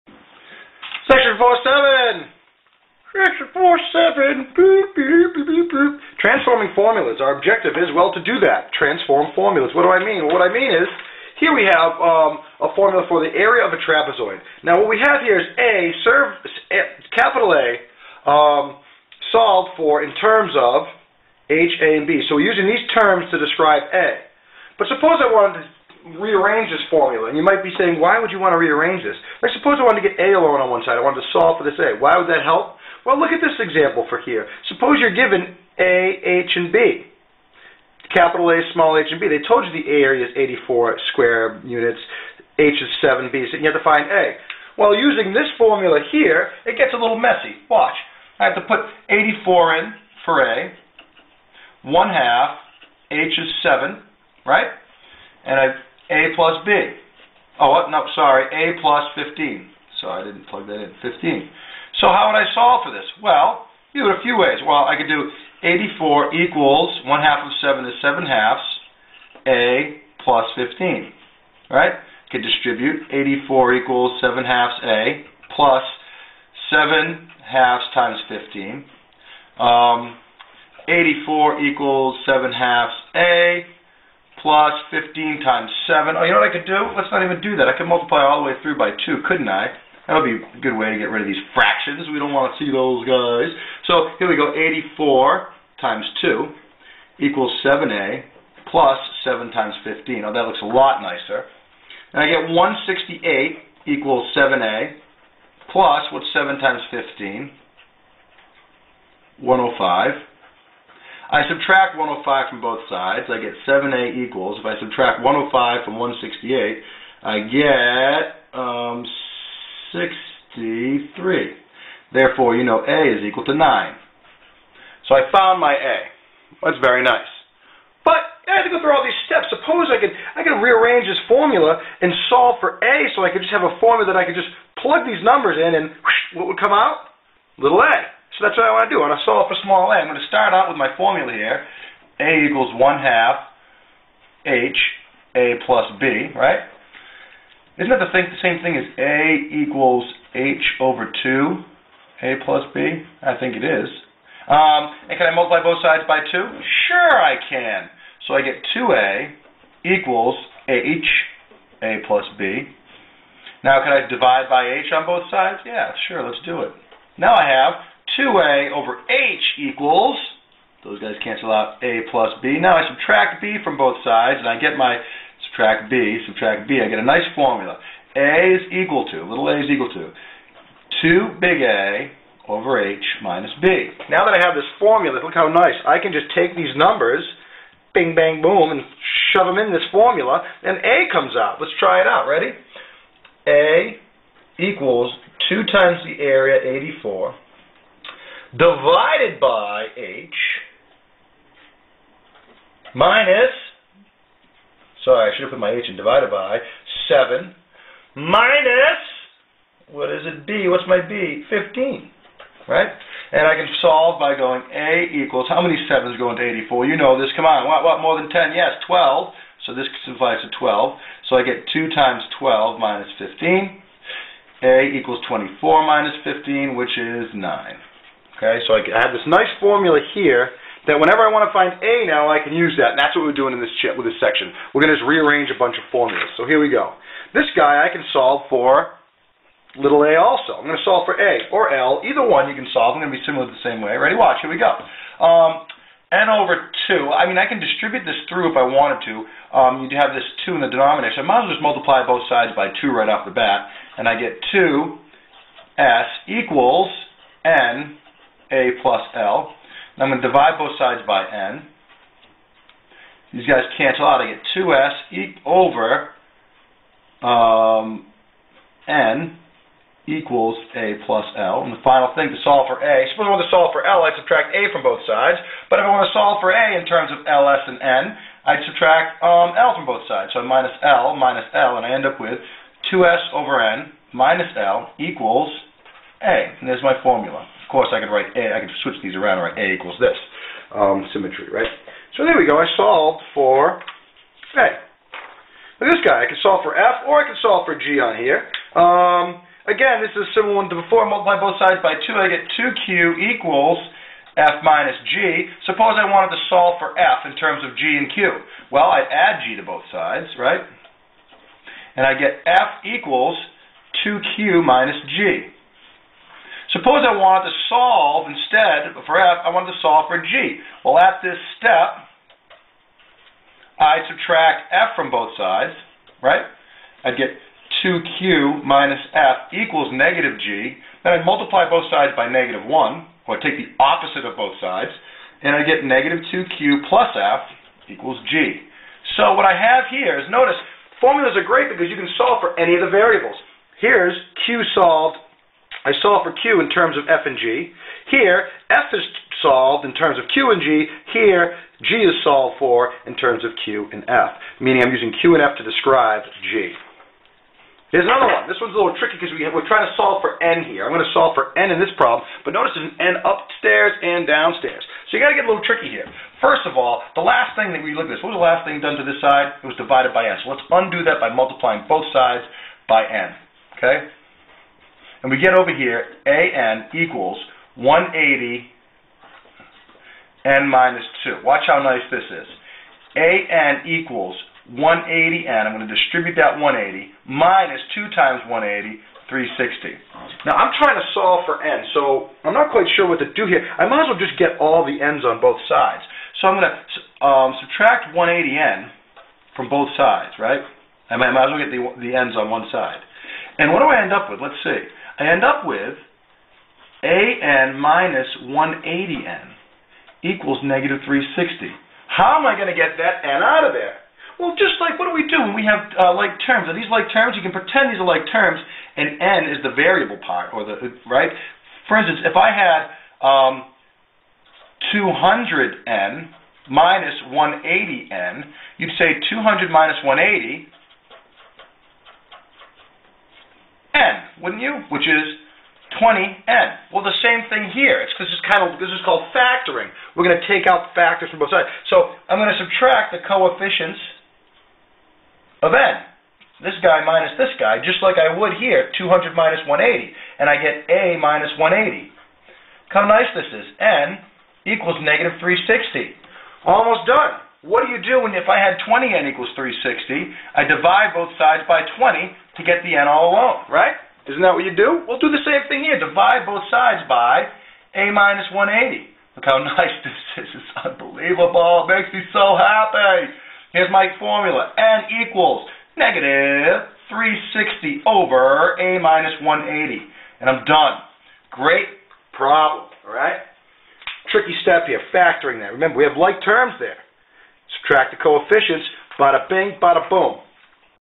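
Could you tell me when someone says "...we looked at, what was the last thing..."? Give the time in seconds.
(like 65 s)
367 s.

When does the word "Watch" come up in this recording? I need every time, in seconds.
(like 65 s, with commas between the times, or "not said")
47 s, 244 s, 381 s.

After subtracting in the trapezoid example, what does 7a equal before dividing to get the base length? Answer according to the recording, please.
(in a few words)
63.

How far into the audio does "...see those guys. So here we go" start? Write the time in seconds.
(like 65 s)
92 s.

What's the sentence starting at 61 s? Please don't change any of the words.
So how would I solve for this?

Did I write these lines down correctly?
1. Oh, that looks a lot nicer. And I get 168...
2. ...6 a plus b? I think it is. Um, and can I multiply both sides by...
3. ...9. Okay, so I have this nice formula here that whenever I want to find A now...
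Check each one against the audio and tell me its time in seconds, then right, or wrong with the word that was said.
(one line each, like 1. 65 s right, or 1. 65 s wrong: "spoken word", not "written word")
1. 100 s right
2. 151 s wrong: "2", not "6"
3. 227 s right.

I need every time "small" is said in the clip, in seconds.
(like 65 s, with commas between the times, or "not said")
38 s, 139 s.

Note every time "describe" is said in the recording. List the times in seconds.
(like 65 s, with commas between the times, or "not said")
23 s, 355 s.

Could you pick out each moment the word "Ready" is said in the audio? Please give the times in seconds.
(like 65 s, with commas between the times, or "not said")
192 s, 243 s.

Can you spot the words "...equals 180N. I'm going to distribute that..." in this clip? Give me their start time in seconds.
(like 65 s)
383 s.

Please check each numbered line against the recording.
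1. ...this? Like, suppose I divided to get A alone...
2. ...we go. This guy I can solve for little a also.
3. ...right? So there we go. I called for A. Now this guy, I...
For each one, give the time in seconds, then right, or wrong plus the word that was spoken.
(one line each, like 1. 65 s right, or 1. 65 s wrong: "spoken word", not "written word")
1. 29 s wrong: "wanted", not "divided"
2. 236 s right
3. 291 s wrong: "solved", not "called".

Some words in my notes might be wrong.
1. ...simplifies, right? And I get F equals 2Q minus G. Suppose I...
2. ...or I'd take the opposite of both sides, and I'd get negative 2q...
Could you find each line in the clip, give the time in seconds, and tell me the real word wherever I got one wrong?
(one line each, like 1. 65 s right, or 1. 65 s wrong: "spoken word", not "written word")
1. 309 s wrong: "sides", not "simplifies"
2. 332 s right.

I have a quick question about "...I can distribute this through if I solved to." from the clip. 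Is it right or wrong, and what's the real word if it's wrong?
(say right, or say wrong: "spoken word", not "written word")
wrong: "wanted", not "solved".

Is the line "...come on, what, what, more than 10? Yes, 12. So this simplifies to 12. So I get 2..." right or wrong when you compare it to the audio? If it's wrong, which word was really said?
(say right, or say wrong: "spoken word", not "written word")
right.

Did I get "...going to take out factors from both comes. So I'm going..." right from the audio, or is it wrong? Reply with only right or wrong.
wrong.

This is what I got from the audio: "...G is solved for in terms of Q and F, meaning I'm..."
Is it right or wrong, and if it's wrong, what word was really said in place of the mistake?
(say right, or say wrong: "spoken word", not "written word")
right.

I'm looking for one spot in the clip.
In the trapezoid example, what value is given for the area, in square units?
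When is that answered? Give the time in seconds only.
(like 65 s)
40 s.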